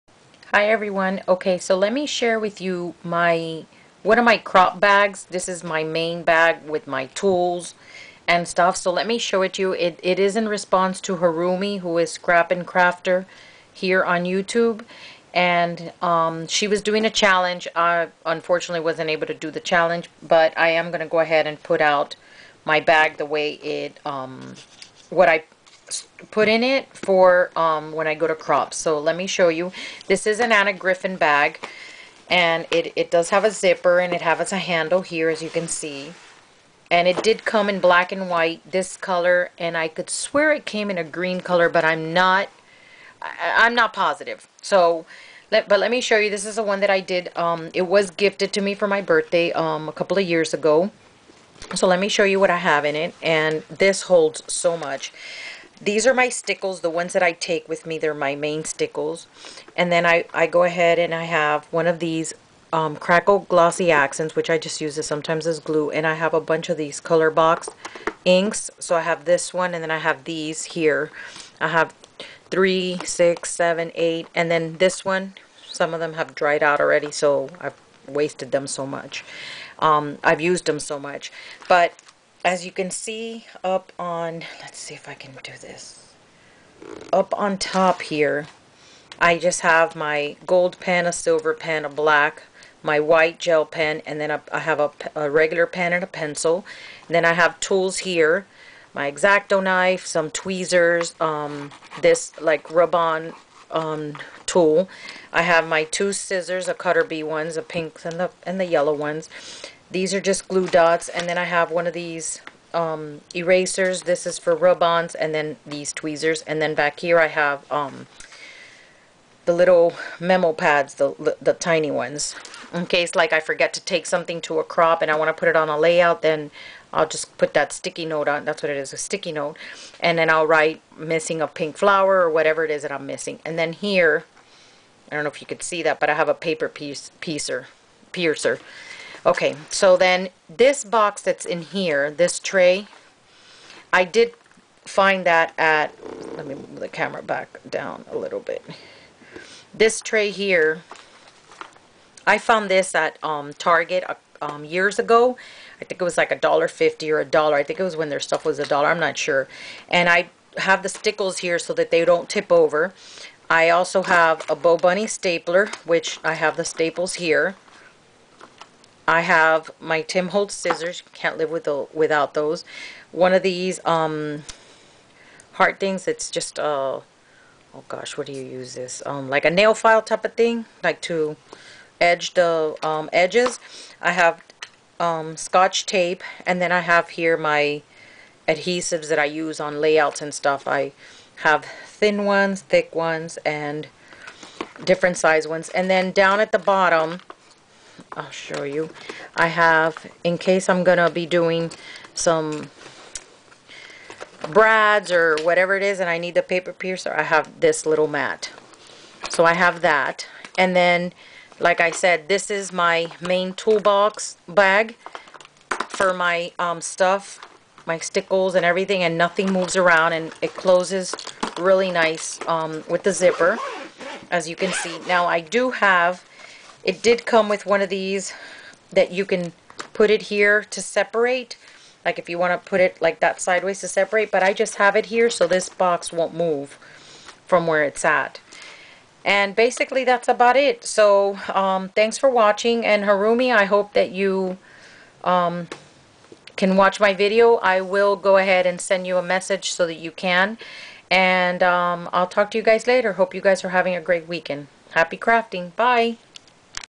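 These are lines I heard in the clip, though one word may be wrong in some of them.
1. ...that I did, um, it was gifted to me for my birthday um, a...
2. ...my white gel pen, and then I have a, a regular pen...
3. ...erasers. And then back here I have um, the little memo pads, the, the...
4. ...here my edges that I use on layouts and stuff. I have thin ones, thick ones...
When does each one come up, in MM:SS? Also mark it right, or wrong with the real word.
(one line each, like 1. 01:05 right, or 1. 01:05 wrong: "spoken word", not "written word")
1. 00:46 right
2. 01:32 right
3. 01:55 wrong: "tweezers", not "erasers"
4. 03:07 wrong: "adhesives", not "edges".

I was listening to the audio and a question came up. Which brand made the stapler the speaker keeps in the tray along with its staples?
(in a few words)
BoBunny.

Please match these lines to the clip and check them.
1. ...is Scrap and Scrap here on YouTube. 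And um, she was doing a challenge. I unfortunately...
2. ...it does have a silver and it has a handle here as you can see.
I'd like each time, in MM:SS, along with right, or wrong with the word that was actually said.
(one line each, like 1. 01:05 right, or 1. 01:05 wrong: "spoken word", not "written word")
1. 00:11 wrong: "Crafter", not "Scrap"
2. 00:32 wrong: "zipper", not "silver".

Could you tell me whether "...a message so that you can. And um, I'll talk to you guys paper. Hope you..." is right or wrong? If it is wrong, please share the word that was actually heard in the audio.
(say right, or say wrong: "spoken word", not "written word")
wrong: "later", not "paper".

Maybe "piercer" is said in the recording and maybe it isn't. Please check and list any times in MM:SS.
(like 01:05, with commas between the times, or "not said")
02:18, 03:26.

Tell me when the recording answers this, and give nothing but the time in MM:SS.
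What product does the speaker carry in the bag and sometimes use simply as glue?
01:02.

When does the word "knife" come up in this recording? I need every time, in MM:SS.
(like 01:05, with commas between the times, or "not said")
01:39.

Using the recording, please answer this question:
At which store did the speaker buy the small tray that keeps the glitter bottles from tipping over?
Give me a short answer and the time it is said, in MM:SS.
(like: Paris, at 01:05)
Target, at 02:33.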